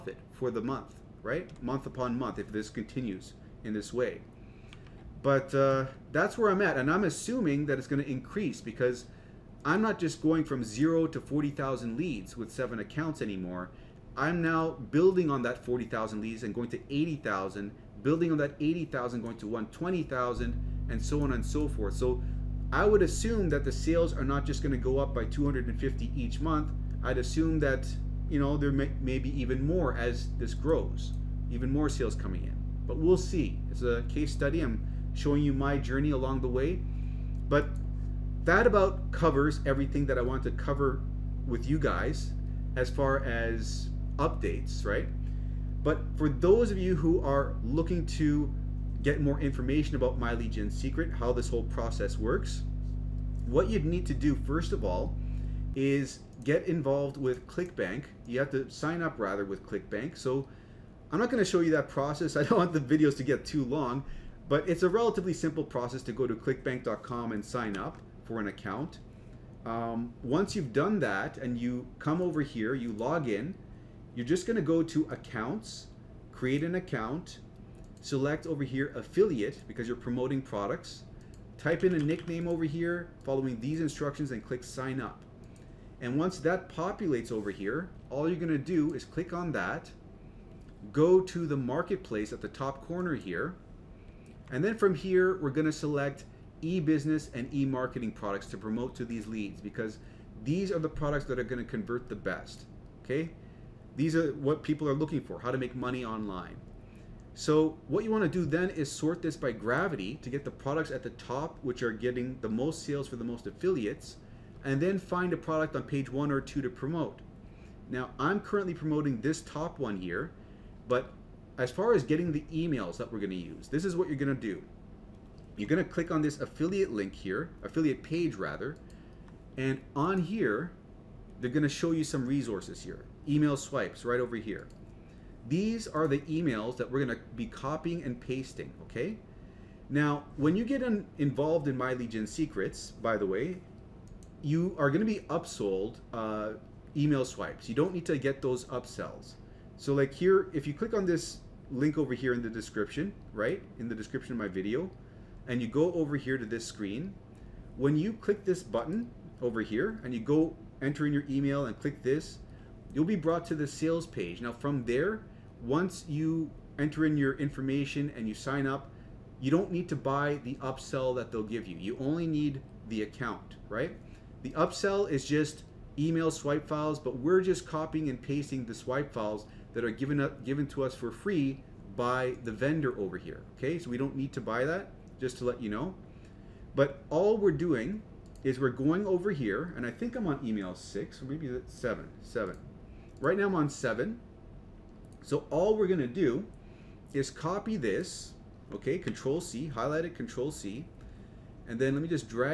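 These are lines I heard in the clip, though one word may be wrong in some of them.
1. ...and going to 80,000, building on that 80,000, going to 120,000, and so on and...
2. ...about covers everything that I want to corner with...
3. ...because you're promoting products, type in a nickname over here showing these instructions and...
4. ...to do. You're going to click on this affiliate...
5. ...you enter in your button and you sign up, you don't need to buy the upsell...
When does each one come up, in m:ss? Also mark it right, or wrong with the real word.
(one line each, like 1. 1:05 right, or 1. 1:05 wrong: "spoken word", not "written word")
1. 0:16 right
2. 0:38 wrong: "cover", not "corner"
3. 1:19 wrong: "following", not "showing"
4. 2:04 right
5. 2:46 wrong: "information", not "button".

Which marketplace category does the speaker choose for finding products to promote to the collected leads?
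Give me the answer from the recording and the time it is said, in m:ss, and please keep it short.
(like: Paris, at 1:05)
e-business and e-marketing, at 1:36.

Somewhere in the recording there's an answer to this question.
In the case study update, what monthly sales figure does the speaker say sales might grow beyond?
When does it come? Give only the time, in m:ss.
0:25.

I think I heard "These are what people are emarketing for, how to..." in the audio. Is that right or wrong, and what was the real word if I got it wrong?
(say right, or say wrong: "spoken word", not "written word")
wrong: "looking", not "emarketing".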